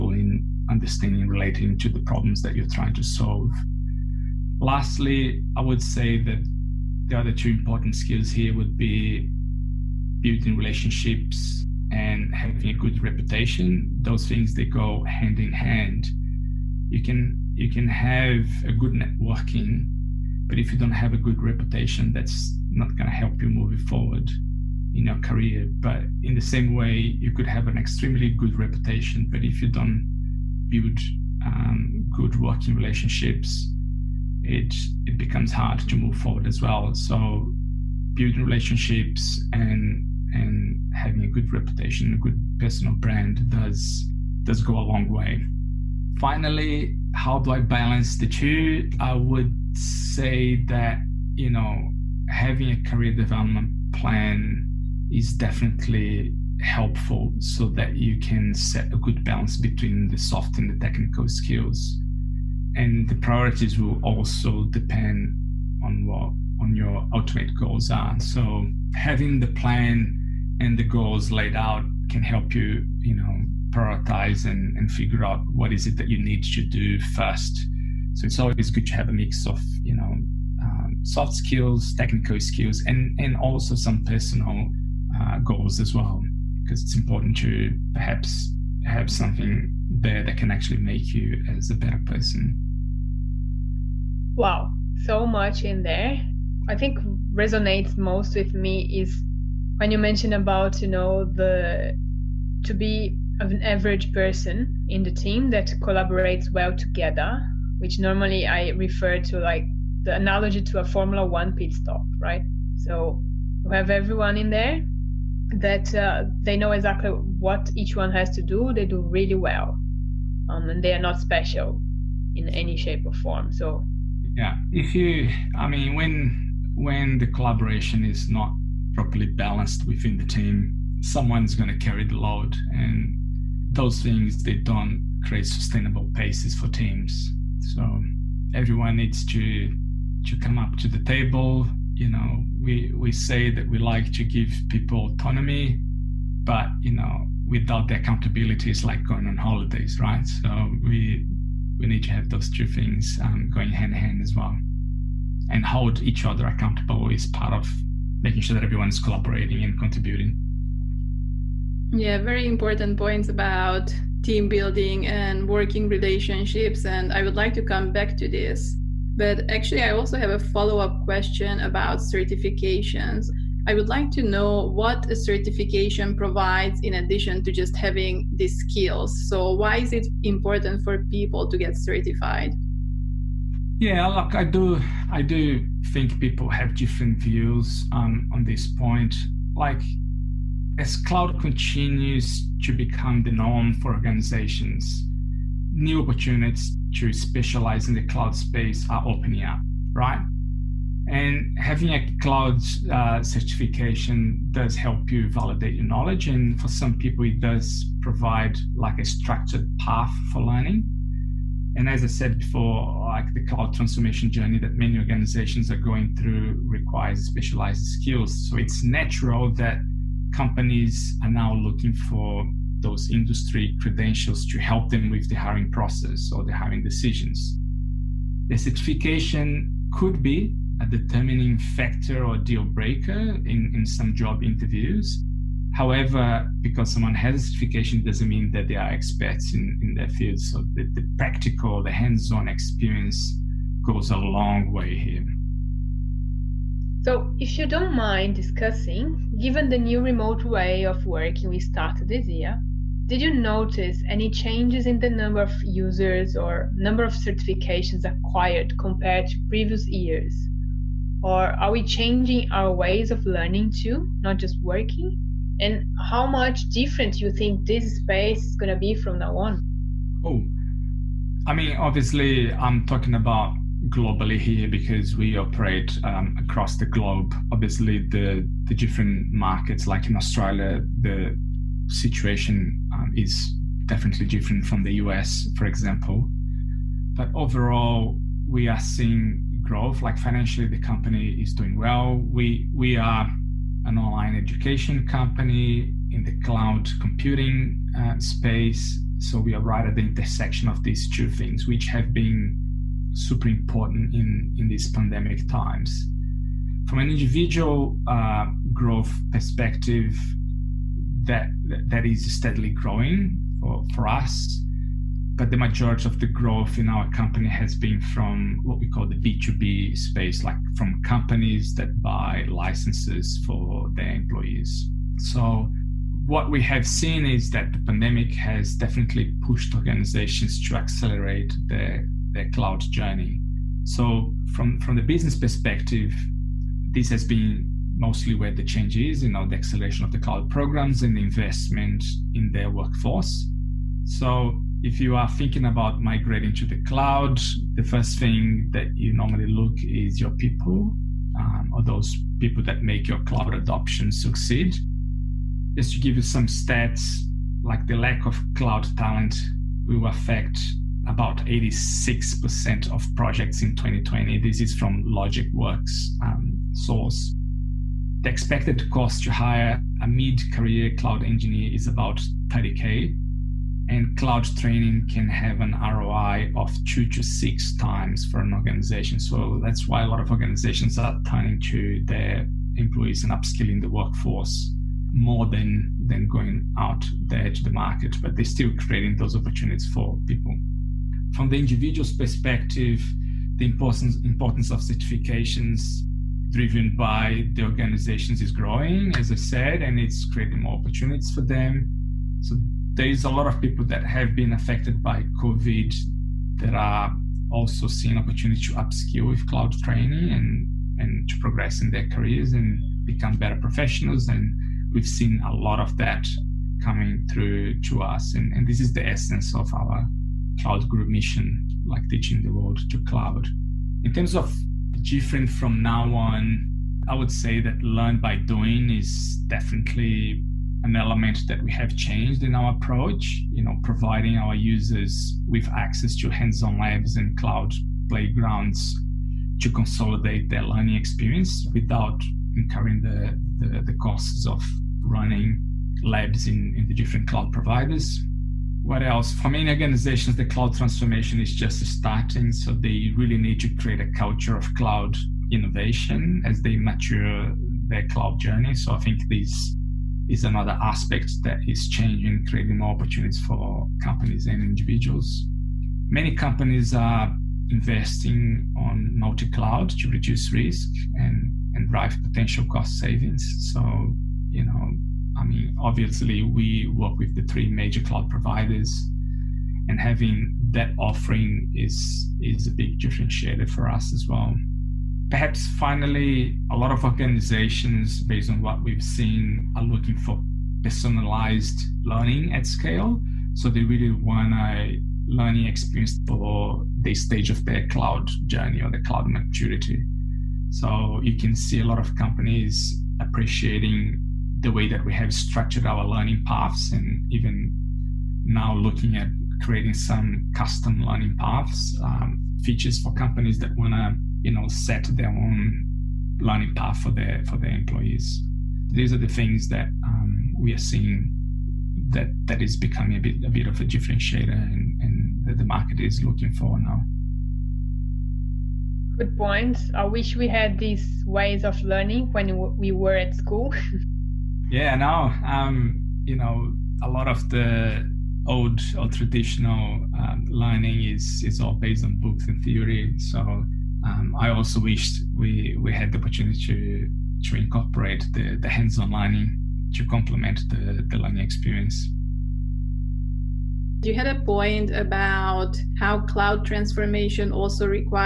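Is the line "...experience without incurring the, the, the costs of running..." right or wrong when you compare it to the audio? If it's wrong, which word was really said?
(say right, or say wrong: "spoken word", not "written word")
right.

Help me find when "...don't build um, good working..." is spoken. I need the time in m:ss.
0:29.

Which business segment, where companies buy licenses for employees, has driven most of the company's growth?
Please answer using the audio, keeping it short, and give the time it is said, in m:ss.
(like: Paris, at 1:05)
B2B, at 5:19.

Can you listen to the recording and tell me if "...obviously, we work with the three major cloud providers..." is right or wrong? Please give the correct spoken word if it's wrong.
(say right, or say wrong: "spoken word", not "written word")
right.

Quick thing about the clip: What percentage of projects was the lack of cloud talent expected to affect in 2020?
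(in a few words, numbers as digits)
86%.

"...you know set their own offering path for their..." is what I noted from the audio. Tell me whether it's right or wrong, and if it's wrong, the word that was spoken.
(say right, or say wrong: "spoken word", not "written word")
wrong: "learning", not "offering".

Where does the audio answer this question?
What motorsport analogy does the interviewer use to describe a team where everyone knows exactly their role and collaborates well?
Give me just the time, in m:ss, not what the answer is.
1:50.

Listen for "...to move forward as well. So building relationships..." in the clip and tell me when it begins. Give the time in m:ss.
0:35.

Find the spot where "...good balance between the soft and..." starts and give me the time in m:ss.
0:58.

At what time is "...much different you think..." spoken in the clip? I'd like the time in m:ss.
4:26.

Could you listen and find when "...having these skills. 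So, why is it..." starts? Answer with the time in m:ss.
2:57.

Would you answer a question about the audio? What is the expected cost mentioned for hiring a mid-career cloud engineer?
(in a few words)
30K.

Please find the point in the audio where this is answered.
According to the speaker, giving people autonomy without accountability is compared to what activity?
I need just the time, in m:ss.
2:29.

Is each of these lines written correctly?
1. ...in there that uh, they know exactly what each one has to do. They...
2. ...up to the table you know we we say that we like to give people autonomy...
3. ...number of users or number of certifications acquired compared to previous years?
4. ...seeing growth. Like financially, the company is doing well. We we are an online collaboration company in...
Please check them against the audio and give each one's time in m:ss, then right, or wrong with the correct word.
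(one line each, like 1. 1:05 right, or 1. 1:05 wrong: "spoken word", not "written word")
1. 1:54 right
2. 2:20 right
3. 4:15 right
4. 4:48 wrong: "education", not "collaboration".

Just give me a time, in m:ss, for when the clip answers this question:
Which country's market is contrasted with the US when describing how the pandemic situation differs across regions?
4:40.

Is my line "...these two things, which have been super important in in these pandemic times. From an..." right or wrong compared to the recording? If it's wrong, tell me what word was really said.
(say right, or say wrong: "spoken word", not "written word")
right.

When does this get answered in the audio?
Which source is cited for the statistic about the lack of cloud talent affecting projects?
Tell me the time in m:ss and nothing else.
6:05.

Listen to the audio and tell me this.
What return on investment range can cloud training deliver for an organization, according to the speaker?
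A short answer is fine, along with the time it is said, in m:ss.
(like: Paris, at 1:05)
2 to 6 times, at 6:16.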